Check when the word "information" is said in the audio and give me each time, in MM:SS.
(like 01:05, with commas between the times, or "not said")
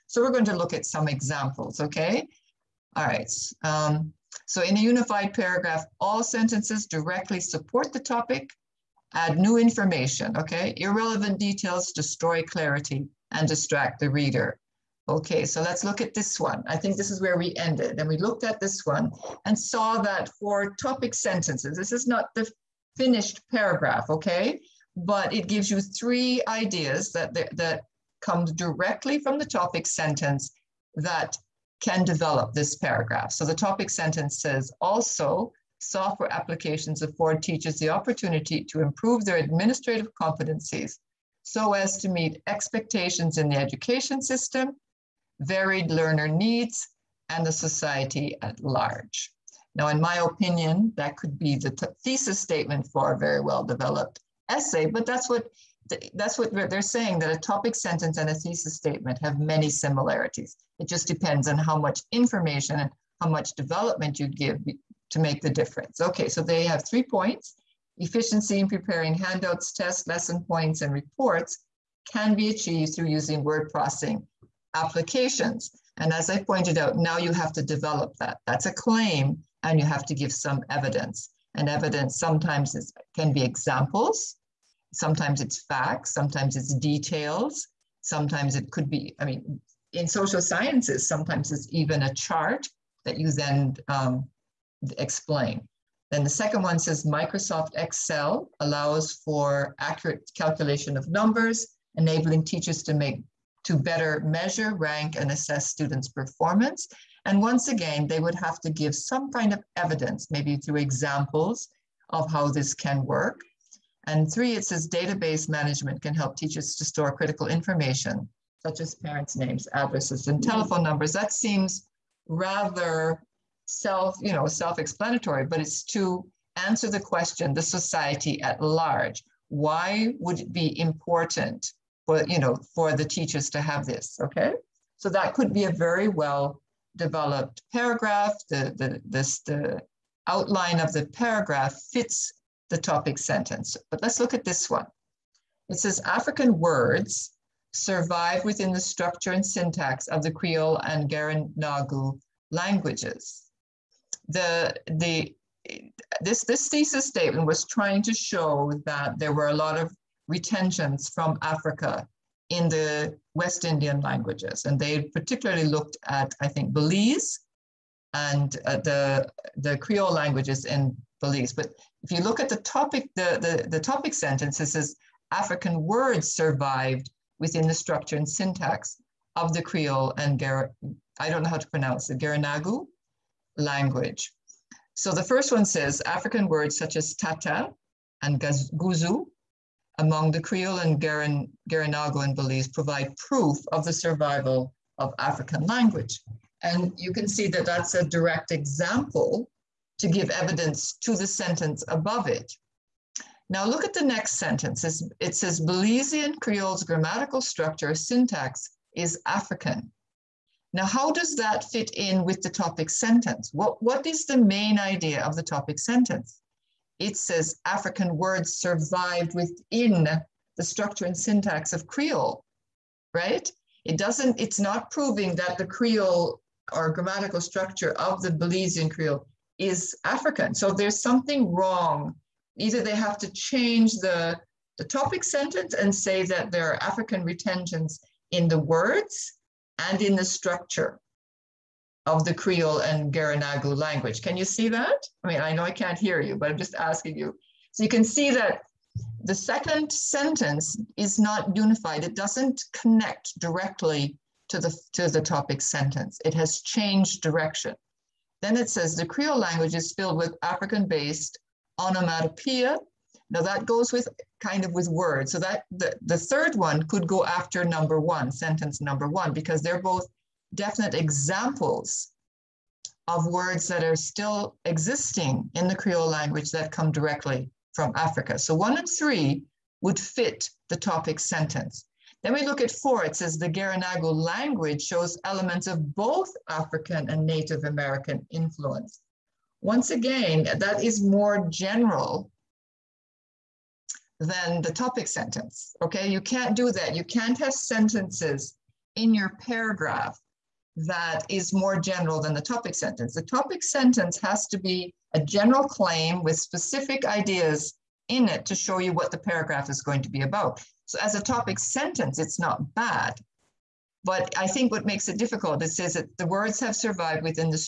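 00:09, 01:02, 01:57.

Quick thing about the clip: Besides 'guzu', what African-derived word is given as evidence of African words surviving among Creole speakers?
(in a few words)
tata.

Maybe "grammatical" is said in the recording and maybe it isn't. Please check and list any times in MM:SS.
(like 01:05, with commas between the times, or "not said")
03:26, 03:46.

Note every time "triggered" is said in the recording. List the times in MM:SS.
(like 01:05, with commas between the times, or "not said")
not said.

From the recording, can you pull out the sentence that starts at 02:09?
Why would it be important for, you know, for the teachers to have this, okay?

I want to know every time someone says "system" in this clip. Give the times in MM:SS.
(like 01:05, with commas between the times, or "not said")
00:44.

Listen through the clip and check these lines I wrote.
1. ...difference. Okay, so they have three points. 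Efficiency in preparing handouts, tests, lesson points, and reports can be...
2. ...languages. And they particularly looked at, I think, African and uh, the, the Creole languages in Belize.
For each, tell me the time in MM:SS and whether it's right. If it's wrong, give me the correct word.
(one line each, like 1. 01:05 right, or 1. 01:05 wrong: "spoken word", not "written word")
1. 01:05 right
2. 02:44 wrong: "Belize", not "African".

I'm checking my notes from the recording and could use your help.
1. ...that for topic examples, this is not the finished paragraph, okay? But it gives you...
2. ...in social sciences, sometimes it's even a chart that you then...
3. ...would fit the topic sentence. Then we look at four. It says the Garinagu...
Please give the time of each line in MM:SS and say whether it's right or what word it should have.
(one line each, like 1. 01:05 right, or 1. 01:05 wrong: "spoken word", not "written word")
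1. 00:20 wrong: "sentences", not "examples"
2. 01:29 right
3. 04:39 right.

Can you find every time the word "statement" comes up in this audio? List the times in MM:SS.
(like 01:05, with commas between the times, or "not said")
00:52, 00:58, 02:37.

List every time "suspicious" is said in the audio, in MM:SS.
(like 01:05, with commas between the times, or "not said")
not said.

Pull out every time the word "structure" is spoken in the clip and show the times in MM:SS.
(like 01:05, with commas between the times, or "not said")
02:28, 02:57, 03:27, 03:40, 03:47, 04:00.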